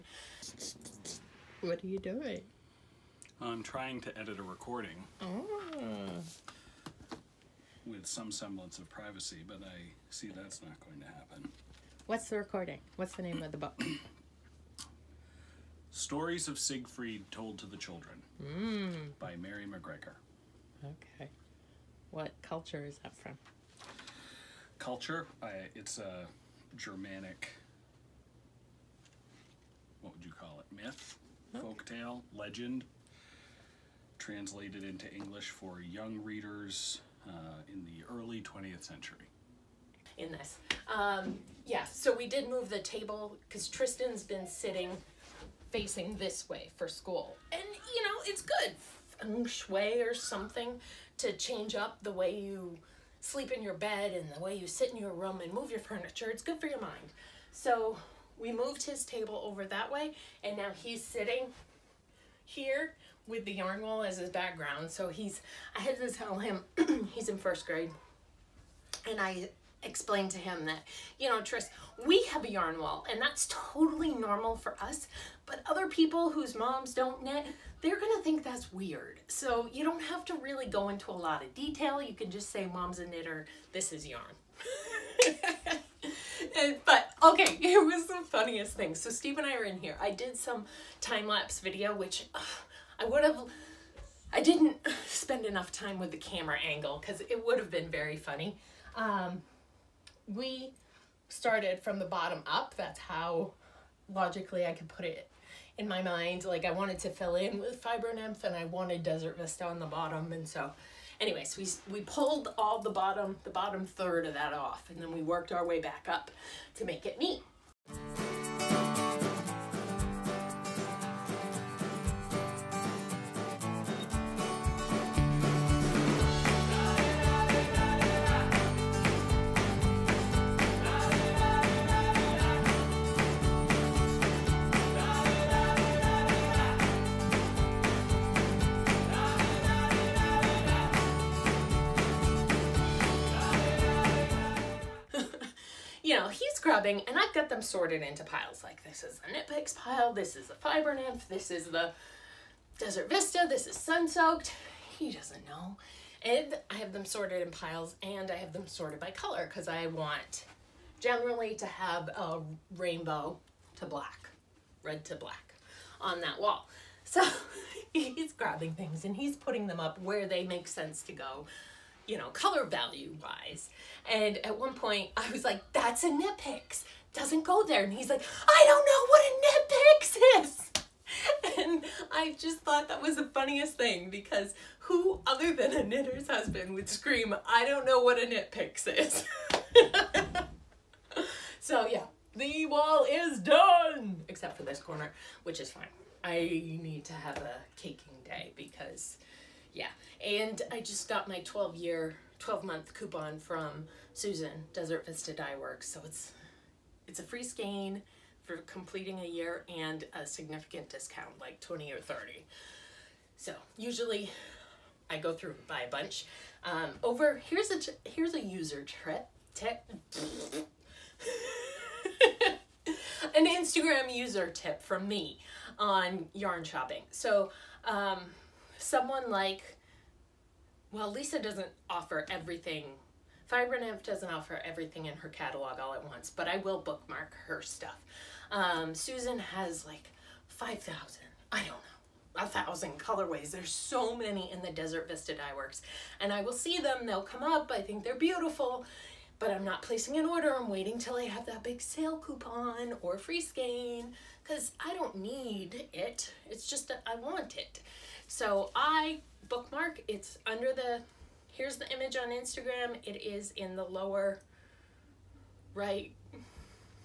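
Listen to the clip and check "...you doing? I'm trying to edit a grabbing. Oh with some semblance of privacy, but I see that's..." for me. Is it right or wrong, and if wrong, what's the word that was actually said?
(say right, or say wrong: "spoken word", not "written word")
wrong: "recording", not "grabbing".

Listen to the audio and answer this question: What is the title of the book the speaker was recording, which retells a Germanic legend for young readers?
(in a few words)
Stories of Siegfried Told to the Children.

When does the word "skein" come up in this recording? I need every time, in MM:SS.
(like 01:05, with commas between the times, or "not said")
03:27, 04:13.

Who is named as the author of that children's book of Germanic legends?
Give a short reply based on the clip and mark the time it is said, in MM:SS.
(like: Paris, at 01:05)
Mary McGregor, at 00:19.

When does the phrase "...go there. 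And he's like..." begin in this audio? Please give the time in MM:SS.
02:57.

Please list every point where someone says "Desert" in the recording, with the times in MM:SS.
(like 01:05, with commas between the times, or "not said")
01:49, 02:32, 03:24, 04:04.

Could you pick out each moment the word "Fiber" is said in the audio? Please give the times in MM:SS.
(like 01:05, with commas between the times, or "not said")
01:47, 02:30, 03:53.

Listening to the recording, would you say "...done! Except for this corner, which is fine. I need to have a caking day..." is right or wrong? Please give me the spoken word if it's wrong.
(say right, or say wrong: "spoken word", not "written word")
right.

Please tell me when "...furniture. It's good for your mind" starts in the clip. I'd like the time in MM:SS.
00:55.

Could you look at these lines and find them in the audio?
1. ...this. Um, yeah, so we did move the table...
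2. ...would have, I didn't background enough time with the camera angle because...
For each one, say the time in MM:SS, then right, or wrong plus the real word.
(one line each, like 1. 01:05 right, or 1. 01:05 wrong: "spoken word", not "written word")
1. 00:40 right
2. 01:33 wrong: "spend", not "background".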